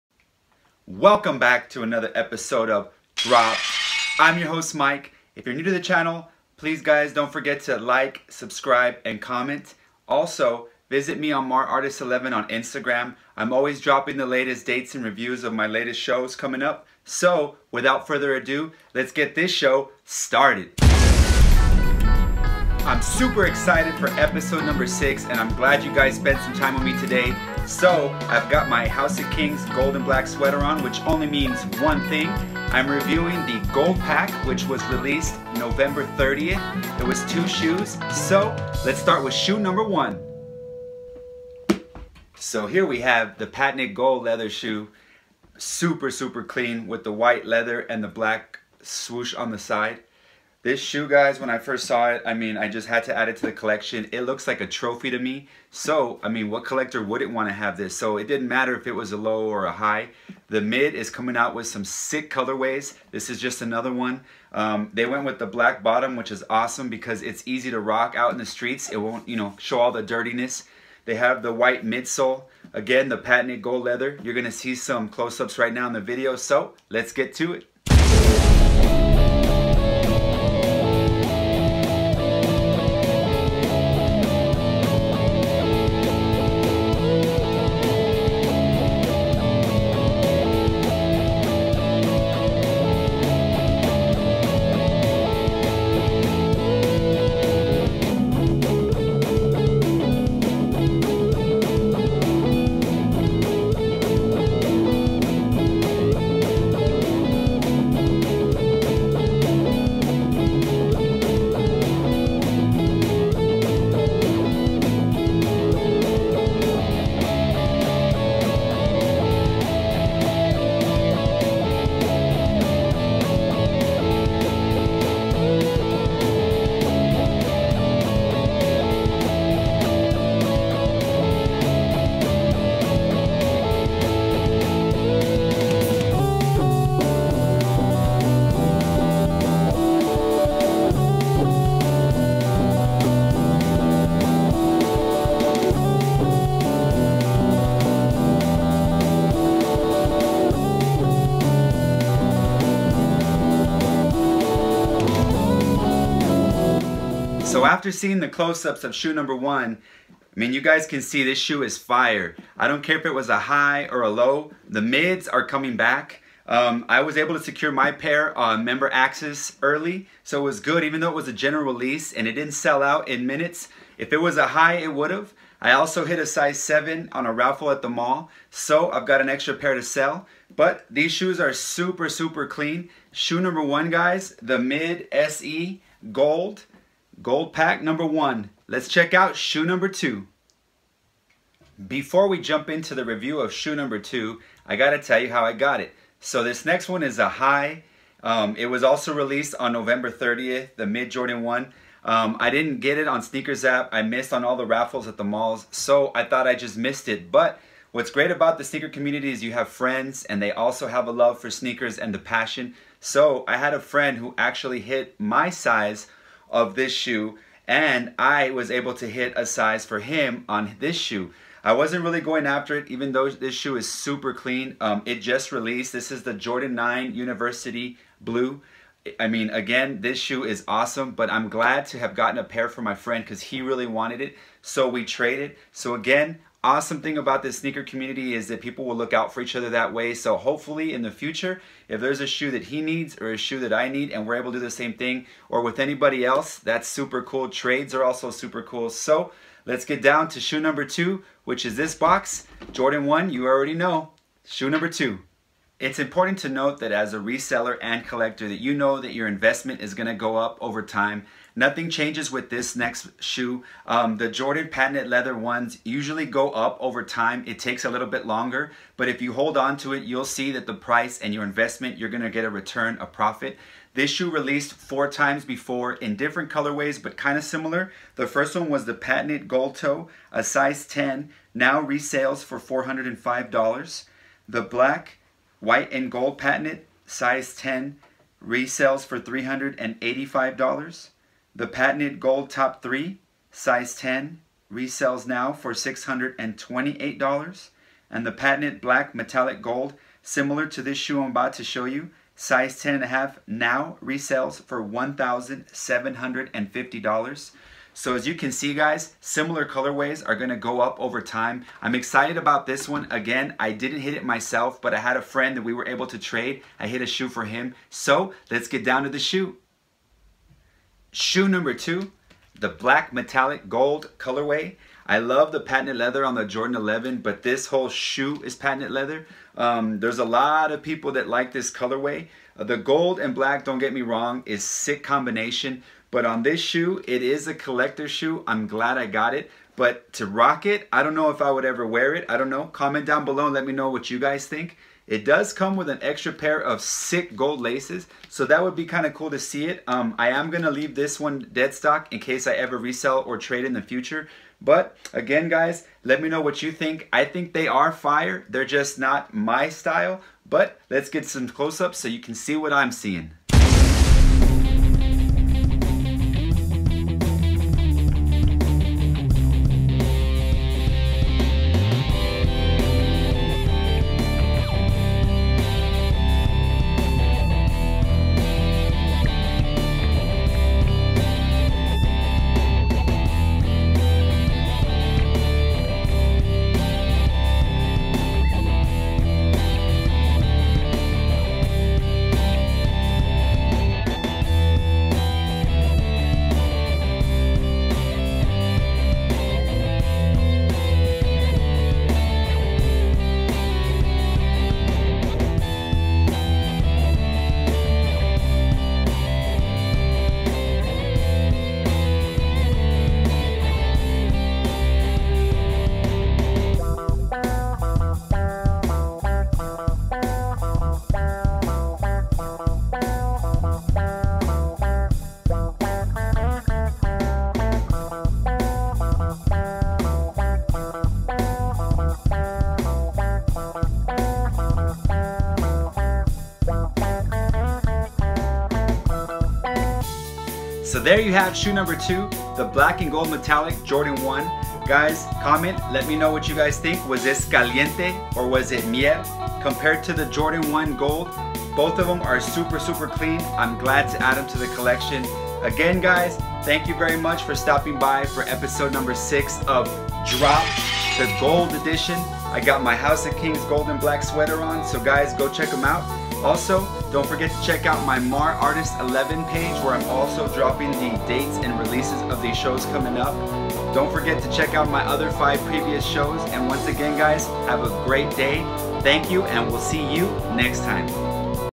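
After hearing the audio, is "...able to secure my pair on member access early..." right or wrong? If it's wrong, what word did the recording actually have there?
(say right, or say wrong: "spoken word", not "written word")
right.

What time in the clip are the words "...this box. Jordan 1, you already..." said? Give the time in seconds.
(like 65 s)
251 s.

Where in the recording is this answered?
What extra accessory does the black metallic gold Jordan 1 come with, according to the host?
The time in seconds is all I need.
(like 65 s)
347 s.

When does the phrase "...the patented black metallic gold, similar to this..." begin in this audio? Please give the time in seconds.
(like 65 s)
298 s.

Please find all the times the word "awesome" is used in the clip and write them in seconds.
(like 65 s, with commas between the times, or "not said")
66 s, 230 s, 236 s.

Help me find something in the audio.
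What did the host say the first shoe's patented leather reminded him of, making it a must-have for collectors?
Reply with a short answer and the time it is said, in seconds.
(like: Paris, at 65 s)
a trophy, at 54 s.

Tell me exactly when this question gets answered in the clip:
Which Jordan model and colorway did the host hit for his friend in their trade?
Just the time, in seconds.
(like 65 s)
226 s.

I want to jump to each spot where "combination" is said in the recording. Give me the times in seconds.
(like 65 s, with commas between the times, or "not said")
335 s.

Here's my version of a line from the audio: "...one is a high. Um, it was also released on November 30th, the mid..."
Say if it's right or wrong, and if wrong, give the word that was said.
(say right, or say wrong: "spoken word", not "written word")
right.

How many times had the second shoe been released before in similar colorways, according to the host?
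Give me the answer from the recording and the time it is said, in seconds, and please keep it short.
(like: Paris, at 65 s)
4, at 274 s.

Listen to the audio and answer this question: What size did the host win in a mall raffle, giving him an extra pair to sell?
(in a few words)
7.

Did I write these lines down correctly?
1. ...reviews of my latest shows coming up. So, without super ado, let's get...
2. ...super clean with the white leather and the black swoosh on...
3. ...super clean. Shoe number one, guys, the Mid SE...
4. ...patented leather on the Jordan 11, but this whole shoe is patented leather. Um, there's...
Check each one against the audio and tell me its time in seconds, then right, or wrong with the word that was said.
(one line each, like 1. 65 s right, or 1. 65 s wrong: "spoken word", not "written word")
1. 15 s wrong: "further", not "super"
2. 46 s right
3. 182 s right
4. 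325 s right.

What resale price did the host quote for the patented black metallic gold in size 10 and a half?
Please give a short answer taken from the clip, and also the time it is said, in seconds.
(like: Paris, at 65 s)
$1,750, at 304 s.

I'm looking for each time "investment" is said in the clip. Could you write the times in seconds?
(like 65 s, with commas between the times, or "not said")
259 s, 271 s.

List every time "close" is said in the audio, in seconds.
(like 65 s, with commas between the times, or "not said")
75 s, 158 s, 361 s.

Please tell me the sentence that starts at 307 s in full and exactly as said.
So as you can see guys, similar colorways are gonna go up over time.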